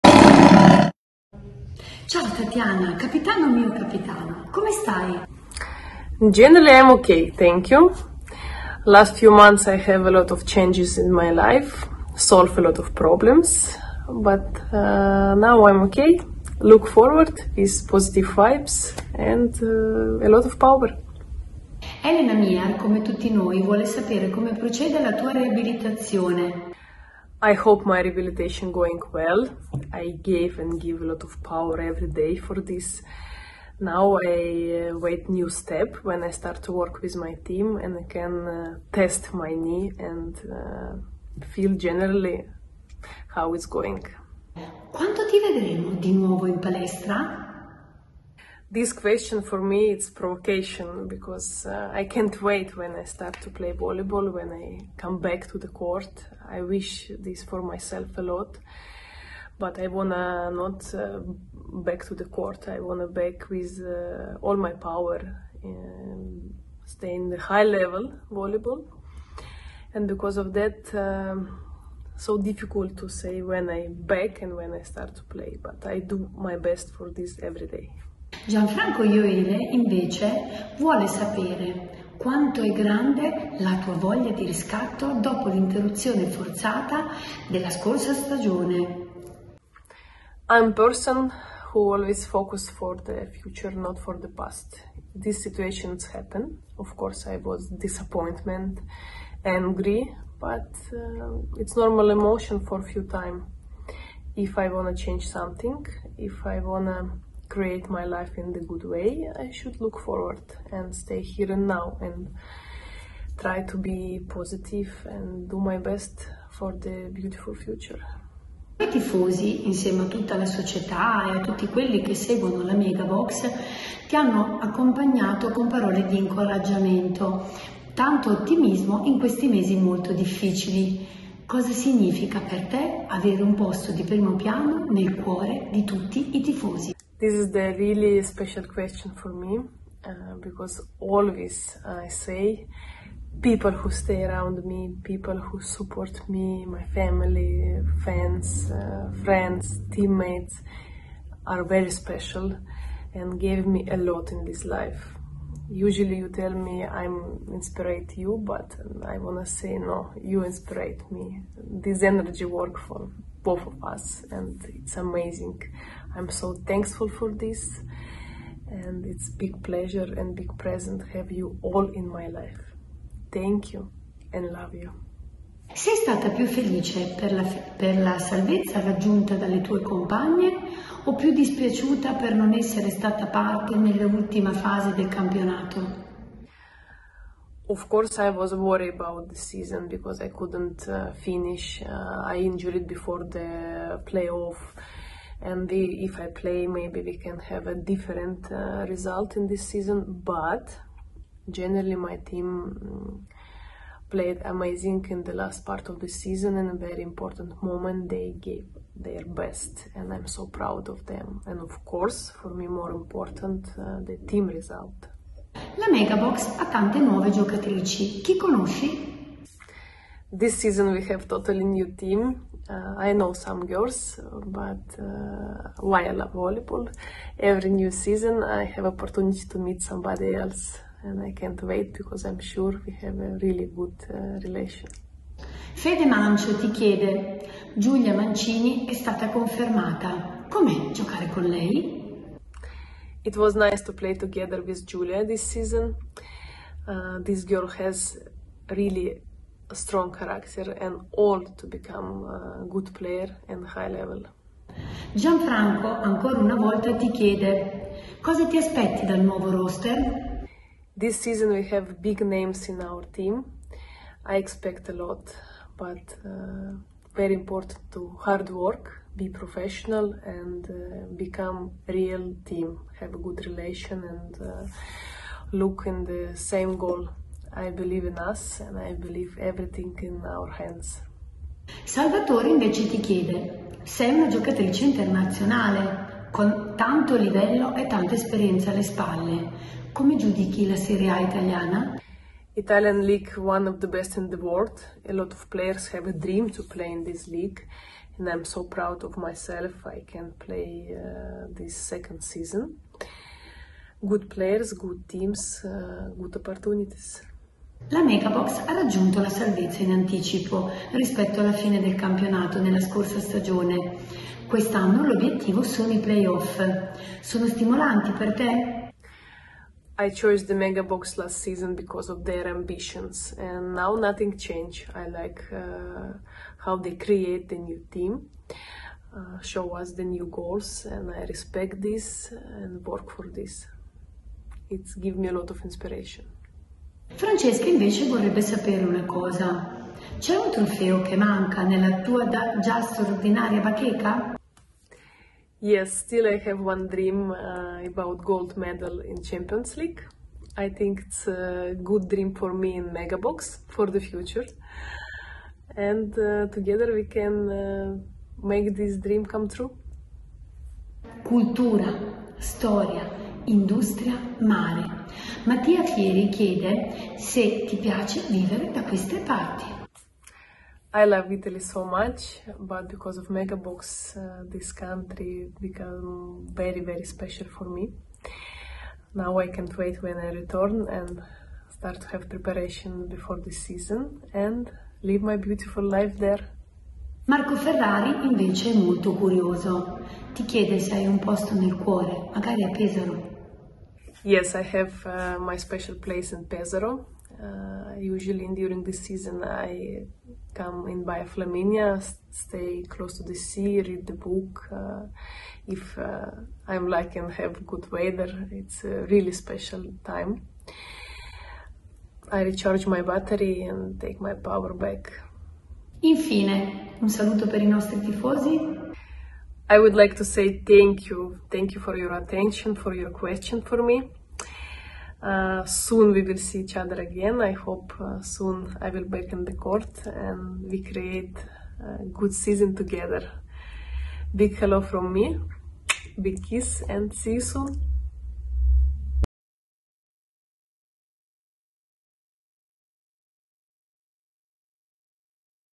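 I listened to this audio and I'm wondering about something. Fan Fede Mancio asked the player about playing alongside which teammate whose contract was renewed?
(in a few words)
Giulia Mancini.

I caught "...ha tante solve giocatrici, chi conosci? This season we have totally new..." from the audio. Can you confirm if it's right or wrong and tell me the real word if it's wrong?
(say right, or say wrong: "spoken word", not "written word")
wrong: "nuove", not "solve".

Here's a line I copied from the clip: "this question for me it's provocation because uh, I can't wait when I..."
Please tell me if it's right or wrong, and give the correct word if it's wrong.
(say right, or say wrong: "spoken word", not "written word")
right.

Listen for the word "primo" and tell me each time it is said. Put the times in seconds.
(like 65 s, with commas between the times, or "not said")
134 s.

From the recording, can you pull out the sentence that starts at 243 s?
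It was nice to play together with Julia this season.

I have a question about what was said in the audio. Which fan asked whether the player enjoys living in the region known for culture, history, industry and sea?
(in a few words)
Mattia Fieri.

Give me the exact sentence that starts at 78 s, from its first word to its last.
Gianfranco Ioele invece vuole sapere quanto è grande la tua voglia di riscatto dopo l'interruzione forzata della scorsa stagione.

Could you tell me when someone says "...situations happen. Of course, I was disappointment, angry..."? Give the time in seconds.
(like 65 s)
95 s.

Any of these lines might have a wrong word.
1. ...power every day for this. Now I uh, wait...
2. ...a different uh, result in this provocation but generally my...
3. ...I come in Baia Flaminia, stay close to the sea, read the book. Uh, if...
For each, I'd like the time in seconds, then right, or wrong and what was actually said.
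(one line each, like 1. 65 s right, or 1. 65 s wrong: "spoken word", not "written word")
1. 31 s right
2. 197 s wrong: "season", not "provocation"
3. 399 s right.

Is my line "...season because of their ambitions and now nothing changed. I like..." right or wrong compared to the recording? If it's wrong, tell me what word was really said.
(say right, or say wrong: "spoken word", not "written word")
right.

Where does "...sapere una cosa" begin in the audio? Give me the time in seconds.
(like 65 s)
338 s.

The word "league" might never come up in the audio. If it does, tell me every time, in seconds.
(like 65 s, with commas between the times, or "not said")
293 s, 297 s, 349 s.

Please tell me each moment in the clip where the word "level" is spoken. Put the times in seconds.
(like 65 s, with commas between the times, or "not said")
67 s, 253 s.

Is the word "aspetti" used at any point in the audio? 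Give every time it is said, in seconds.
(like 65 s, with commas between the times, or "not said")
258 s.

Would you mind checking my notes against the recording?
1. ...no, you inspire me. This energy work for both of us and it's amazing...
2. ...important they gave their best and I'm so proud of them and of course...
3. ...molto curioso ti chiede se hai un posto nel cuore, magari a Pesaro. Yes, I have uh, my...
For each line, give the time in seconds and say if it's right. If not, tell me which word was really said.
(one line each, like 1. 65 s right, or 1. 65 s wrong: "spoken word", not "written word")
1. 159 s right
2. 207 s wrong: "moment", not "important"
3. 388 s right.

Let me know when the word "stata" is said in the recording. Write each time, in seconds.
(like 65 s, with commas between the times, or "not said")
175 s, 182 s, 238 s.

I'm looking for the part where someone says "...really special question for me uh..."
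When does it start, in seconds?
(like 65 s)
137 s.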